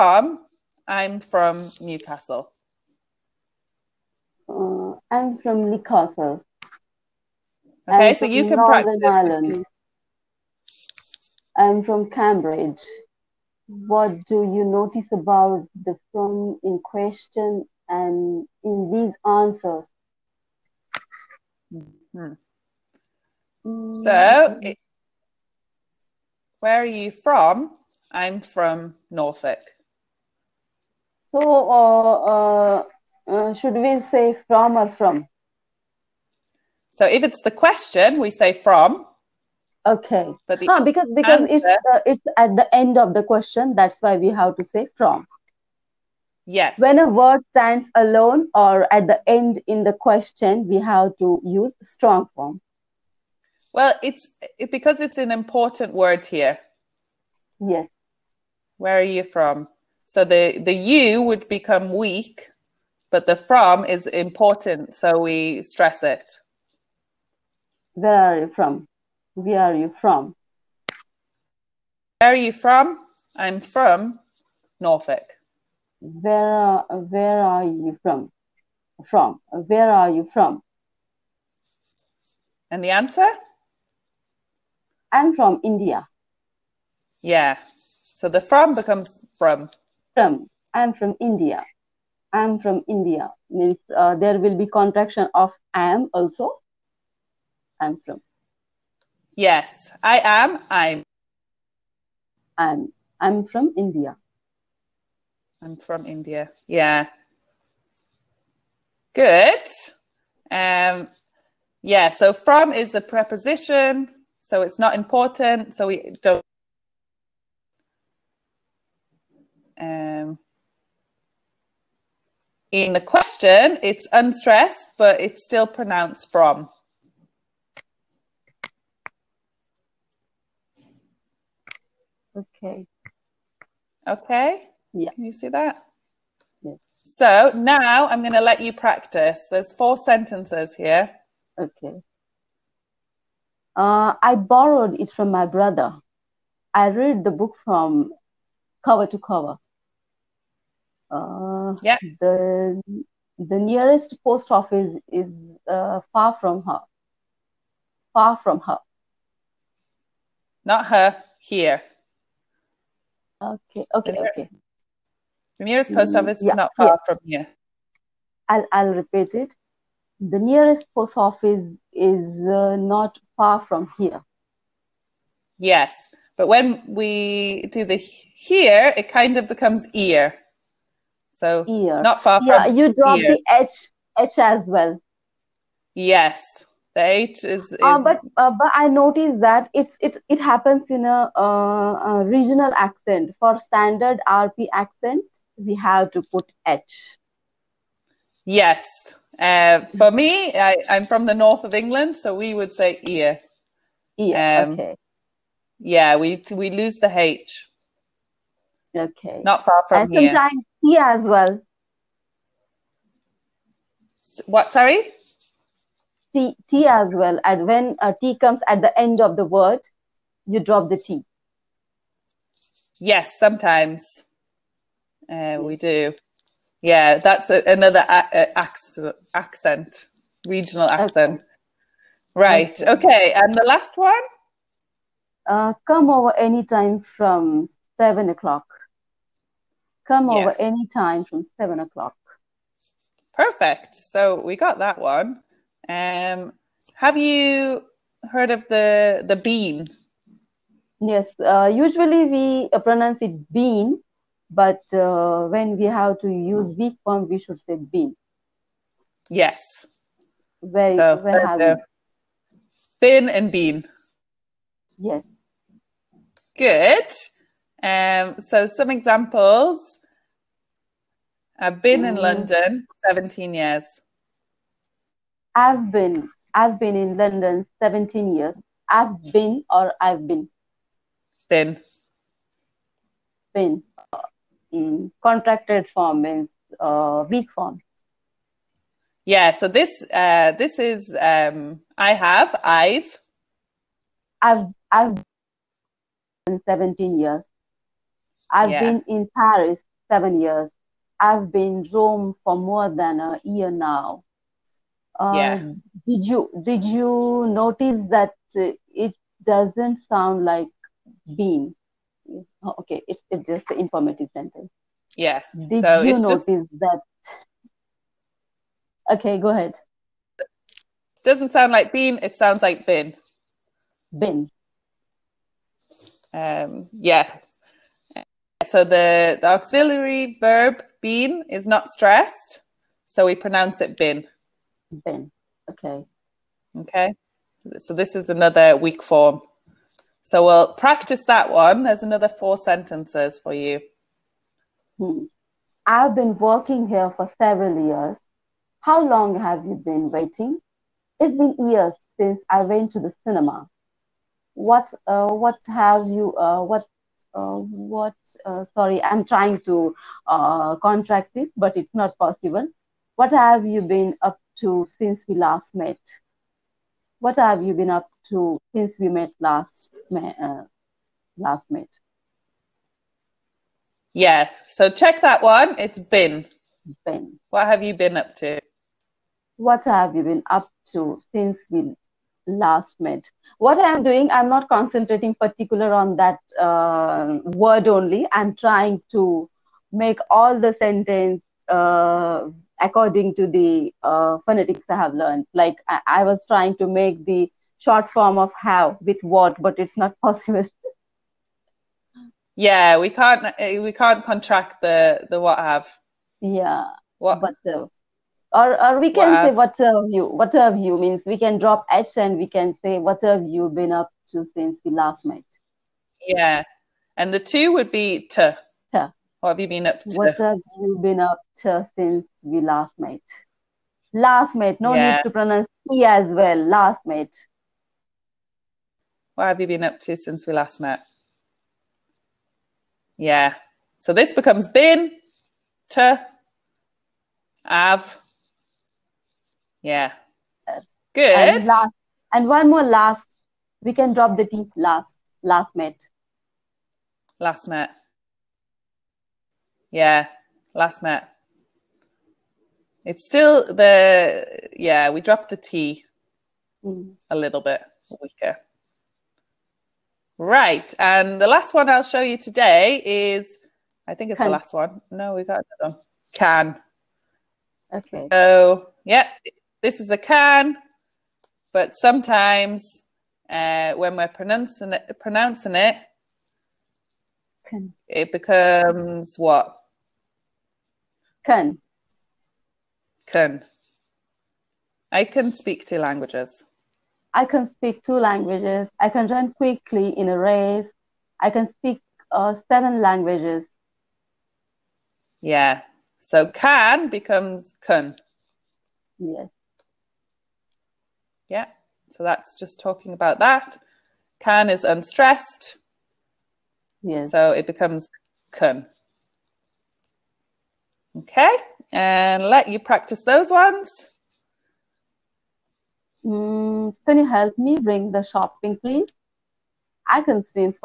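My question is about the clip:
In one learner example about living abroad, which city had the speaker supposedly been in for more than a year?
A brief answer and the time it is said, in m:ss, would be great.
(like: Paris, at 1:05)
Rome, at 5:01.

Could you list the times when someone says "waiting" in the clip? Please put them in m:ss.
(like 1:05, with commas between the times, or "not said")
5:50.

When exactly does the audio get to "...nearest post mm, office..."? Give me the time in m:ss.
2:45.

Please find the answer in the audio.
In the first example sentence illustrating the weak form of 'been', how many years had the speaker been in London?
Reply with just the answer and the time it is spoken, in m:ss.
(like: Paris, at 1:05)
17, at 4:31.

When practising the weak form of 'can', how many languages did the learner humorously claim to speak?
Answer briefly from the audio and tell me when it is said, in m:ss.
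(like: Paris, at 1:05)
7, at 8:11.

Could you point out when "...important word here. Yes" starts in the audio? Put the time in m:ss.
0:55.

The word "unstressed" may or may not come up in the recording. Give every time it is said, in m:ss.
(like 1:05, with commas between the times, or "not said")
2:04, 8:24.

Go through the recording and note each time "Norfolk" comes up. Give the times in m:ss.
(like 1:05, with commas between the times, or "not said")
0:29, 1:14.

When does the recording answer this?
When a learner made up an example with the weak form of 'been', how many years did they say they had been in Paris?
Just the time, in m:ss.
4:58.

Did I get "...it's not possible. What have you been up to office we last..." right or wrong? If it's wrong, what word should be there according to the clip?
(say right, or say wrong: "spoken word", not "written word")
wrong: "since", not "office".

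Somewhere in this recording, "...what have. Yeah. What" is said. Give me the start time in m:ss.
6:45.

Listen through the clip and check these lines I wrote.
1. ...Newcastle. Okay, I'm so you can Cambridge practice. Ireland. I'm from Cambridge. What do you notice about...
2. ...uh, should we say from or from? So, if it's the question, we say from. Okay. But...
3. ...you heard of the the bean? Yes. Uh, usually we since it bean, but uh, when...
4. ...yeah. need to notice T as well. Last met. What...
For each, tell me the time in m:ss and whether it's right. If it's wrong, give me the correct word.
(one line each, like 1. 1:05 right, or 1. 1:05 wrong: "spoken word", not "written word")
1. 0:05 wrong: "Northern", not "Cambridge"
2. 0:33 right
3. 4:07 wrong: "pronounce", not "since"
4. 7:04 wrong: "pronounce", not "notice".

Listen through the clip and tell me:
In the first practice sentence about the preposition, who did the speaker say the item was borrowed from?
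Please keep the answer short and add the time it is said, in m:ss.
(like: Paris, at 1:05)
my brother, at 2:24.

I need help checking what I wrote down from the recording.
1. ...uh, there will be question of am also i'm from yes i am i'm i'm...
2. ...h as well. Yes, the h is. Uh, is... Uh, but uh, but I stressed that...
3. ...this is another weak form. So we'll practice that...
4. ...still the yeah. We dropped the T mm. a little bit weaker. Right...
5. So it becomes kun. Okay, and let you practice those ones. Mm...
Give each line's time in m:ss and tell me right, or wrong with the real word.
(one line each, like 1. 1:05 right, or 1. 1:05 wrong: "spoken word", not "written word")
1. 1:33 wrong: "contraction", not "question"
2. 3:04 wrong: "noticed", not "stressed"
3. 5:37 right
4. 7:33 right
5. 8:27 right.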